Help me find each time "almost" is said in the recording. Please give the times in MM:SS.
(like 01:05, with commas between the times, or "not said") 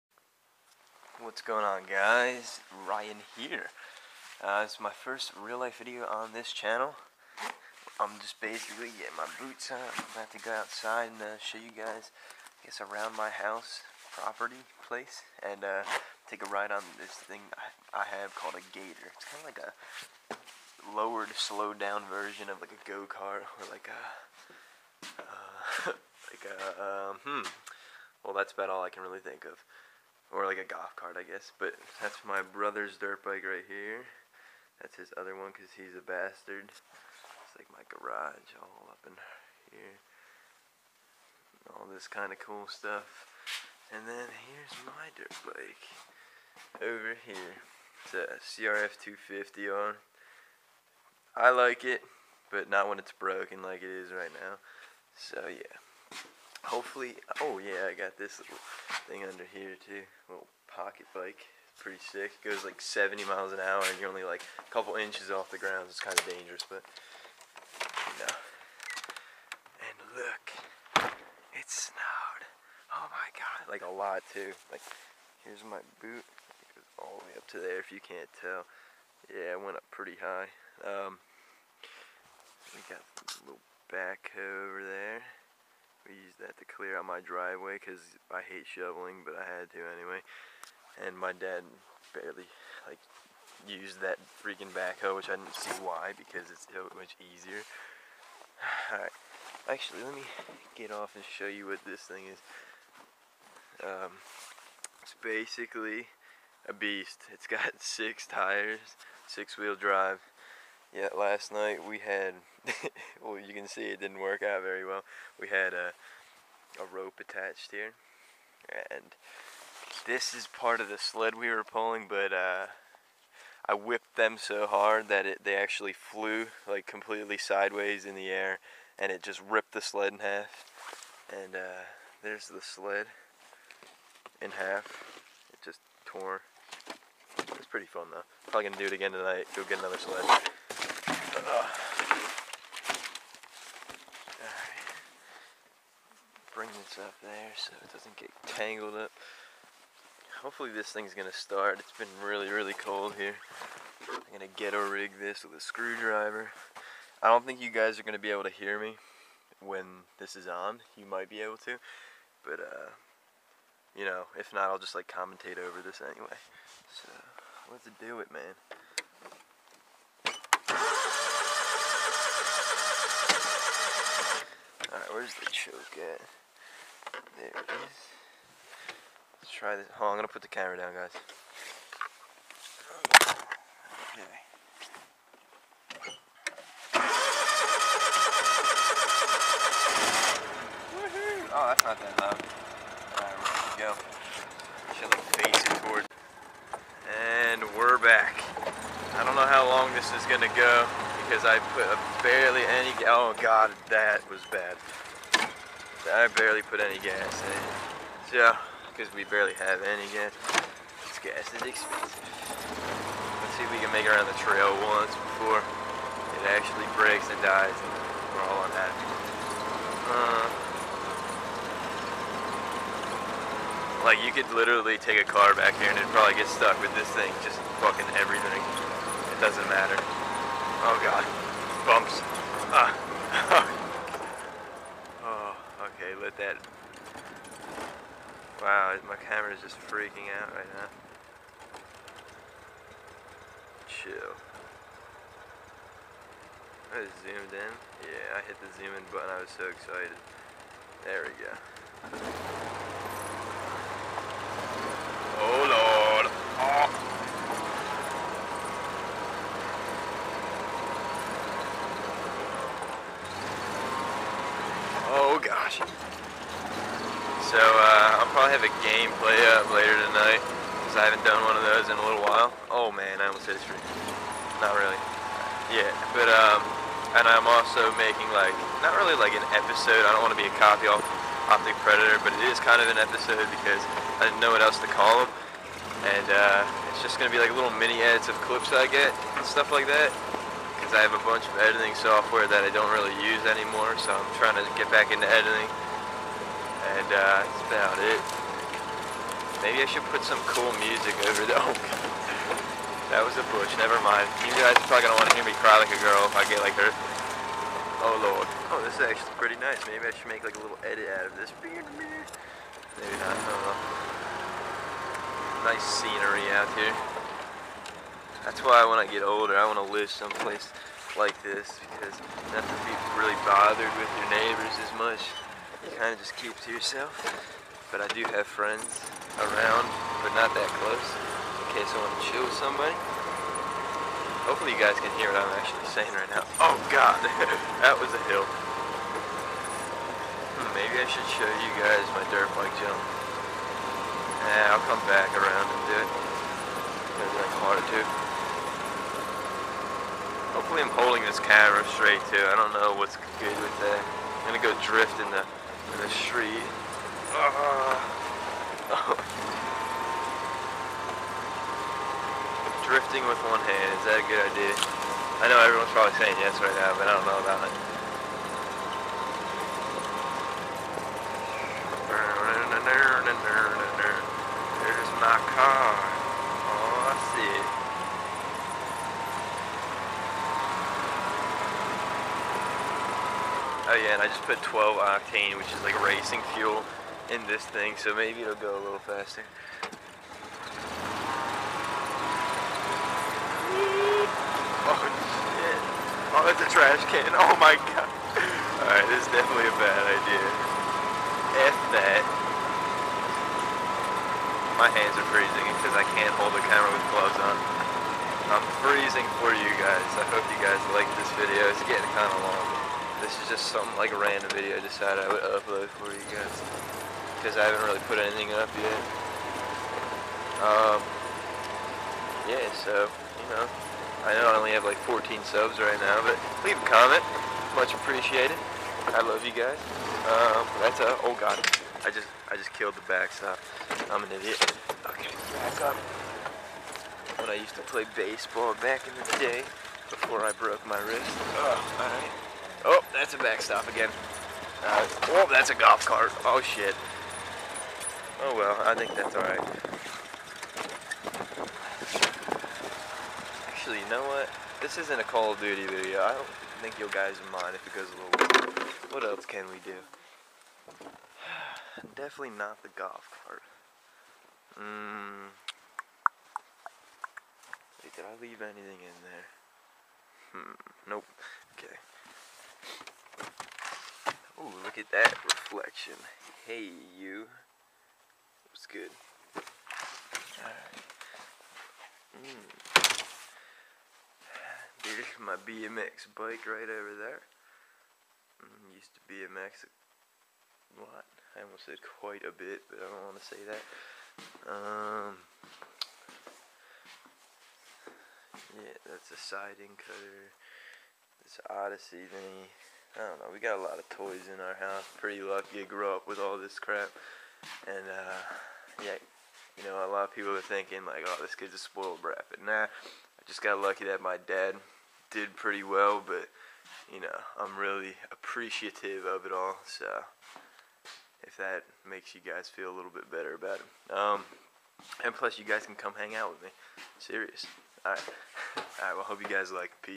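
04:33, 08:11.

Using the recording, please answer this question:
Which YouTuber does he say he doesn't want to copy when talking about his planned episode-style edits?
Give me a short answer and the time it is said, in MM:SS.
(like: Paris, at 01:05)
Optic Predator, at 04:41.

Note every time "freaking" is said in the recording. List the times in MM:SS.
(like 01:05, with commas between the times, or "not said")
01:34, 03:59.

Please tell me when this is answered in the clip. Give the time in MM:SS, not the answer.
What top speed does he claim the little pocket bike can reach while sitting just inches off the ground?
01:02.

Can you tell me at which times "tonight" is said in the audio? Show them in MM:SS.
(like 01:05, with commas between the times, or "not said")
02:19, 04:30.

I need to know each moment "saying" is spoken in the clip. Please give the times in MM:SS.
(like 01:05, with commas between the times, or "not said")
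05:35, 06:06.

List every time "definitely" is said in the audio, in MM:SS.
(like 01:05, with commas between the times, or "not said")
06:39, 07:42.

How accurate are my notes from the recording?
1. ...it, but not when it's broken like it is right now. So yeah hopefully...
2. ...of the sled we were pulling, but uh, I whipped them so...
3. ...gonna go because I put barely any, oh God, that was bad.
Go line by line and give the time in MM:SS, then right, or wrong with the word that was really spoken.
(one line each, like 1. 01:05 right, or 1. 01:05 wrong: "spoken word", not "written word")
1. 00:51 right
2. 02:00 right
3. 03:20 right.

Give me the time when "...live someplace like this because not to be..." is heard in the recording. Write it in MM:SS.
05:19.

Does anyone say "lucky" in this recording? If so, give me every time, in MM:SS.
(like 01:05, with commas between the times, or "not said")
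08:25, 08:33.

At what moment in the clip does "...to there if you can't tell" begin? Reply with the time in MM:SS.
01:17.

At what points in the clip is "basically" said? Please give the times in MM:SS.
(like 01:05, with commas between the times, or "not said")
00:08, 01:45.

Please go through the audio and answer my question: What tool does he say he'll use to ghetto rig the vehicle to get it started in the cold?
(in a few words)
screwdriver.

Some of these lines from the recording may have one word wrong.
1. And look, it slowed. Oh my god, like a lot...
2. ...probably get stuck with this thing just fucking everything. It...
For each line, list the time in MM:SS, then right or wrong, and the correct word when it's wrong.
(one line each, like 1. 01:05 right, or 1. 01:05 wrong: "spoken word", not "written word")
1. 01:09 wrong: "snowed", not "slowed"
2. 03:46 right.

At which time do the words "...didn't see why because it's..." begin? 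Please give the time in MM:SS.
01:35.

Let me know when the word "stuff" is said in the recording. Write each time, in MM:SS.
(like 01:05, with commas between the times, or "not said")
00:42, 04:49.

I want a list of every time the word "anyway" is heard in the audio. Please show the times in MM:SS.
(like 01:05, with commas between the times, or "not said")
01:29, 02:46.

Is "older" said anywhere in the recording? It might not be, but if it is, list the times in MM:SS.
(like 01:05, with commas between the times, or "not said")
05:19.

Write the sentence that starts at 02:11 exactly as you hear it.
And uh, there's the sled in half.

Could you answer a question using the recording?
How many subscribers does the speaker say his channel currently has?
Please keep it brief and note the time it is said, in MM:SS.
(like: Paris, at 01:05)
14, at 07:05.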